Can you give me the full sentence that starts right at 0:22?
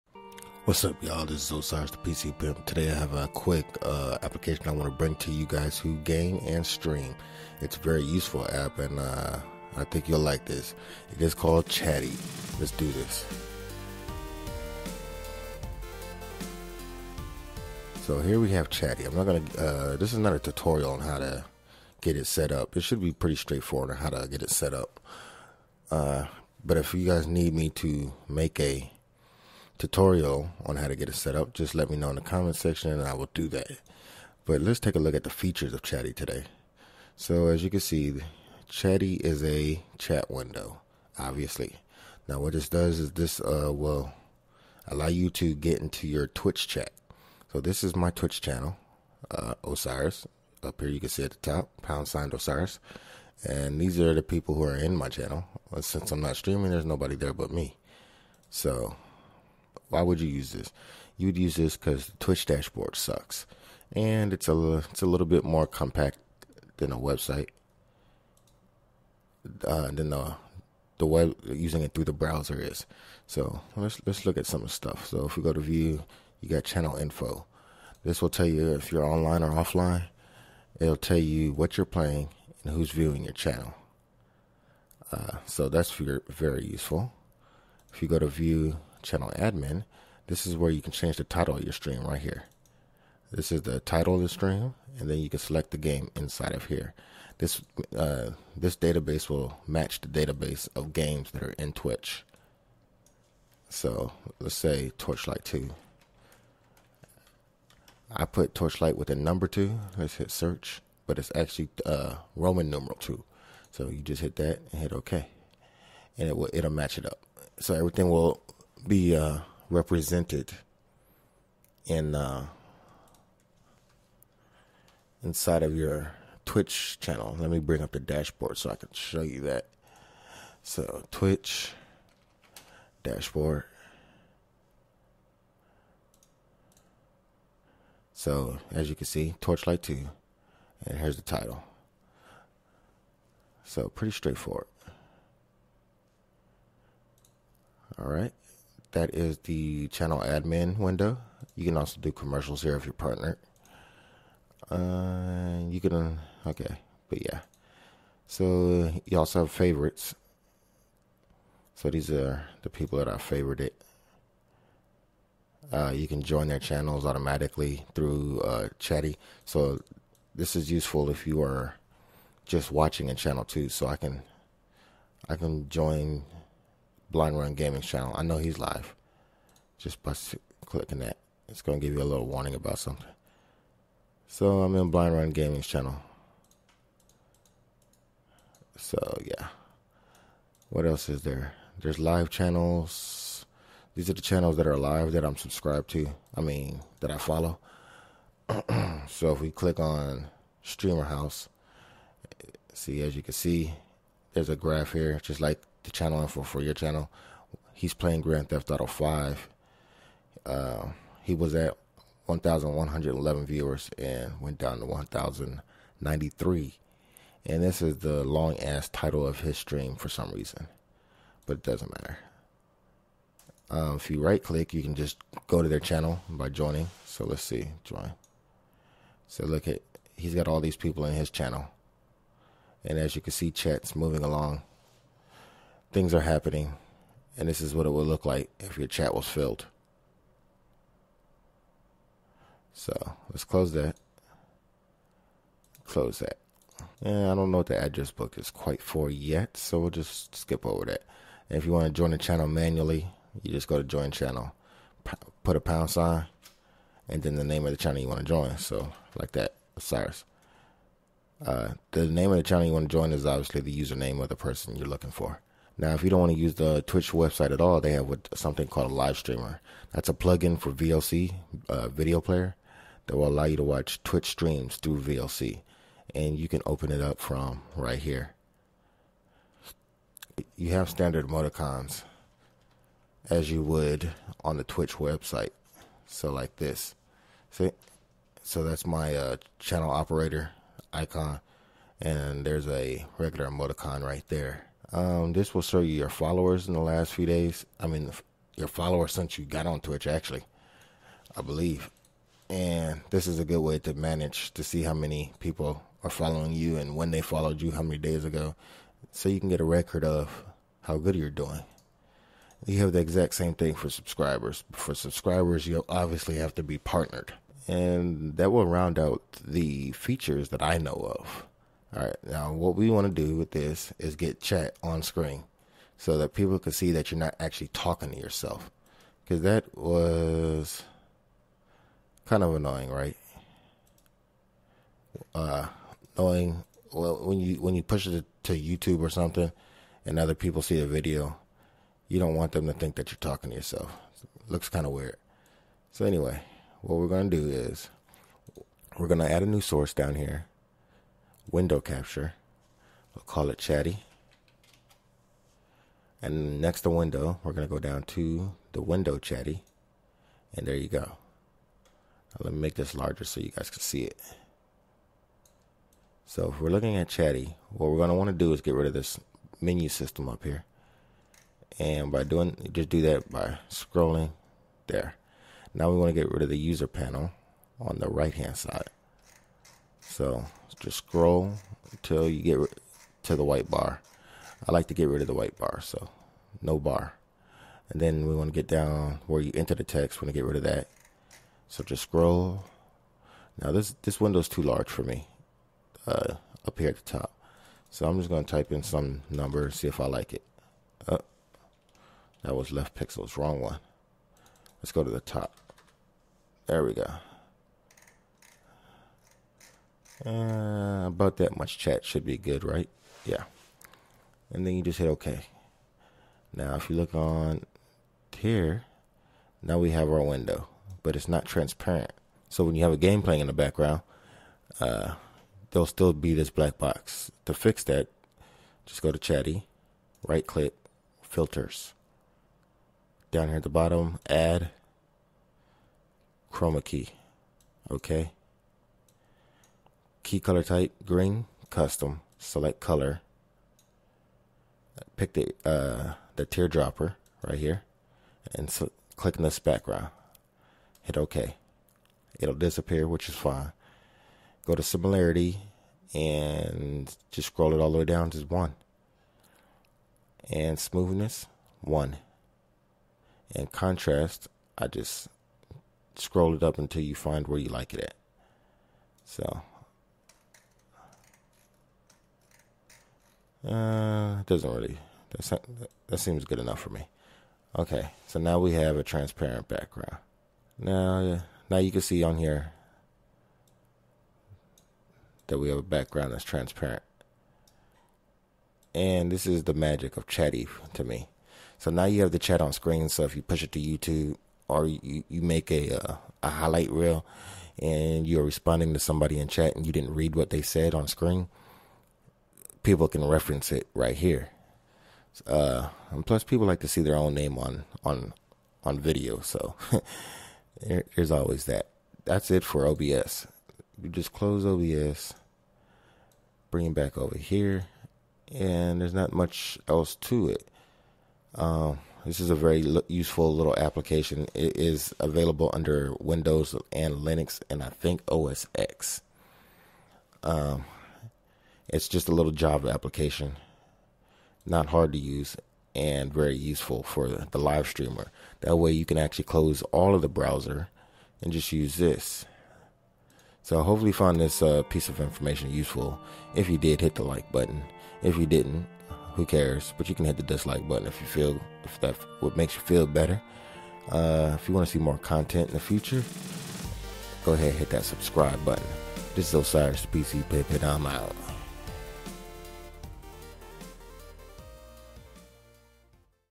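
It should be pretty straightforward on how to get it set up.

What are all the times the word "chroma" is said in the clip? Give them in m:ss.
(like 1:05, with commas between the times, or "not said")
7:16.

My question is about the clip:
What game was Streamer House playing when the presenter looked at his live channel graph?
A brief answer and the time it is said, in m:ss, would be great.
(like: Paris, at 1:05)
Grand Theft Auto 5, at 3:28.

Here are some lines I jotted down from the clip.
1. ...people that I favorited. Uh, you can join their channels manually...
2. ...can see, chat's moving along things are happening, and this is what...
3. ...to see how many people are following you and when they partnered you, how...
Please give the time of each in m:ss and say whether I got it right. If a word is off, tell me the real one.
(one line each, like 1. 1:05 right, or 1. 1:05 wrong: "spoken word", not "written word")
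1. 2:42 wrong: "automatically", not "manually"
2. 3:53 right
3. 5:04 wrong: "followed", not "partnered".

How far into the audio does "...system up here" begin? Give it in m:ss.
6:09.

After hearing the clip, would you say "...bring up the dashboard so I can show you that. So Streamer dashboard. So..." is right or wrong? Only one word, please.
wrong.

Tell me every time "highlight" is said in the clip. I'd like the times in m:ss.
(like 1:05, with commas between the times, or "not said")
8:16.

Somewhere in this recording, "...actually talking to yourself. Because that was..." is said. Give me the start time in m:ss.
5:27.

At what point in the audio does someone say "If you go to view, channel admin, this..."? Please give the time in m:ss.
1:27.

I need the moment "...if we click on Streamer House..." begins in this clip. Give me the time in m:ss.
3:19.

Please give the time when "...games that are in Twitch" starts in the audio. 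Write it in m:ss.
1:40.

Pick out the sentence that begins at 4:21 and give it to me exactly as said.
Uh, the name of the channel you want to join is obviously the username of the person you're looking for.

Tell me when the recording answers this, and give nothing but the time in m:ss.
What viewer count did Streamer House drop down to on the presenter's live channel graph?
3:34.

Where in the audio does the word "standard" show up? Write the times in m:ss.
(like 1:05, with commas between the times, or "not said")
4:40.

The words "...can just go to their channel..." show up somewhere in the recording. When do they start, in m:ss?
3:44.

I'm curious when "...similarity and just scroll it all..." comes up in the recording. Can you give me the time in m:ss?
7:34.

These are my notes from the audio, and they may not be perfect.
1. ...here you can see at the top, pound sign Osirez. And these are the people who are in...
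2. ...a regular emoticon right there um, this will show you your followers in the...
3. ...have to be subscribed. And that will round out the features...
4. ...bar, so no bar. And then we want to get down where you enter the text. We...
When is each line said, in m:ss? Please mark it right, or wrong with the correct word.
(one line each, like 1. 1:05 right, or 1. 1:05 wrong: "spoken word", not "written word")
1. 0:50 right
2. 4:52 right
3. 5:16 wrong: "partnered", not "subscribed"
4. 6:25 right.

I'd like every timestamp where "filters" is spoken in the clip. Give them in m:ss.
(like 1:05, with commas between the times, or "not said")
7:11.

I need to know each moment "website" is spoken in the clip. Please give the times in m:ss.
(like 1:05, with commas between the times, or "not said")
1:06, 4:27, 4:44.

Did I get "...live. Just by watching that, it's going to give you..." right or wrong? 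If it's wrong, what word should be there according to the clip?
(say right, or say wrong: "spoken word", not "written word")
wrong: "clicking", not "watching".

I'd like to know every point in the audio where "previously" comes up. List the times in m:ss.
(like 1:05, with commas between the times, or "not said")
not said.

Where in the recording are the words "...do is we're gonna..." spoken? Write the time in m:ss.
5:47.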